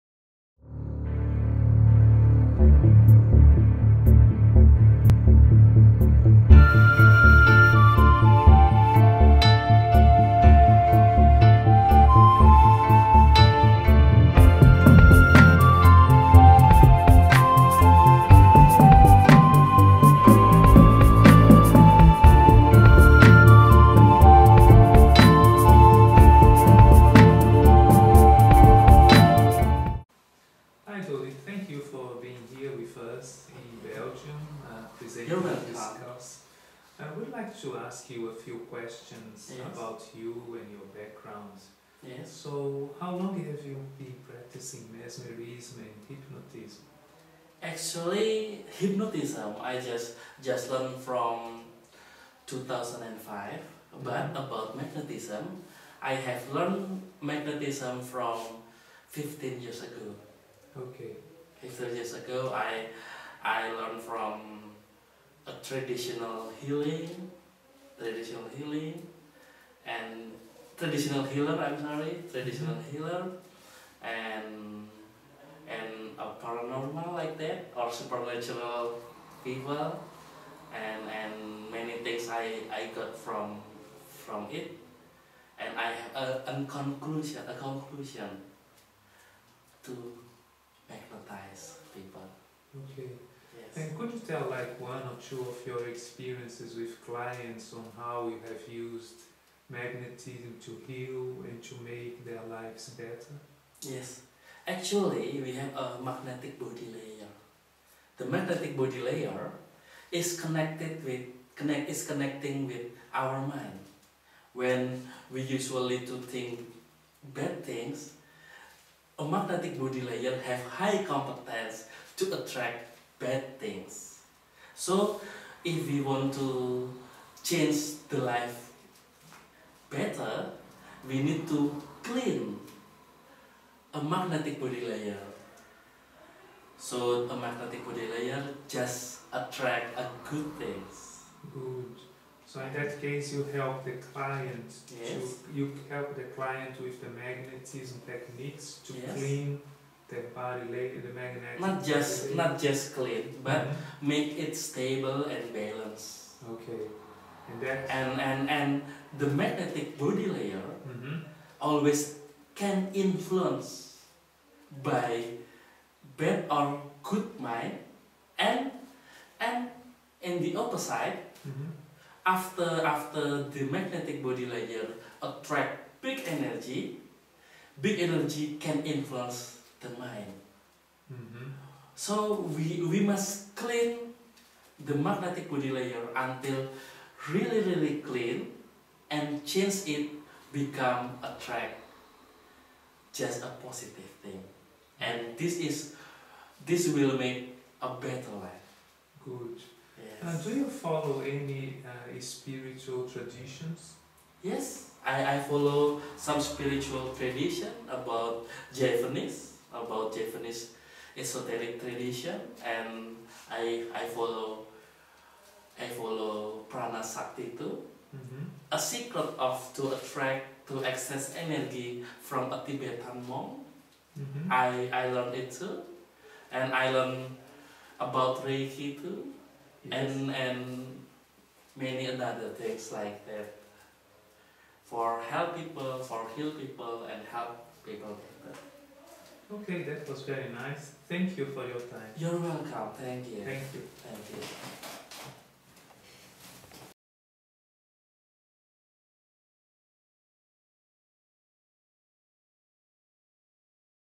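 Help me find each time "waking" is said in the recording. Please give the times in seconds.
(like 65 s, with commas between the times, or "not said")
not said.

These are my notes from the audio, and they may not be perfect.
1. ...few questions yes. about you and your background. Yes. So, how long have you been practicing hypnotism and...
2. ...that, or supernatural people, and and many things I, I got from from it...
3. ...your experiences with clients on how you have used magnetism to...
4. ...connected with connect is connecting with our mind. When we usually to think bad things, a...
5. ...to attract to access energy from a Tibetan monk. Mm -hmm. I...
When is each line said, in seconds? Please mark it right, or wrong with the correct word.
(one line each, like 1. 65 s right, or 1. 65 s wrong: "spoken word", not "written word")
1. 38 s wrong: "mesmerism", not "hypnotism"
2. 77 s right
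3. 95 s right
4. 110 s right
5. 219 s right.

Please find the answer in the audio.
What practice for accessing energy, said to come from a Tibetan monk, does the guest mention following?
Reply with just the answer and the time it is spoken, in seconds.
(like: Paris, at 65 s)
Prana sakti, at 216 s.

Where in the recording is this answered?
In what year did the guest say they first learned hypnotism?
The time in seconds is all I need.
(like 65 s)
52 s.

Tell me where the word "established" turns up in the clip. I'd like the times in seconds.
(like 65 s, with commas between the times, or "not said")
not said.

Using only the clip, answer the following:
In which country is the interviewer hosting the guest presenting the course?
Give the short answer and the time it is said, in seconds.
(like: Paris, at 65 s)
Belgium, at 33 s.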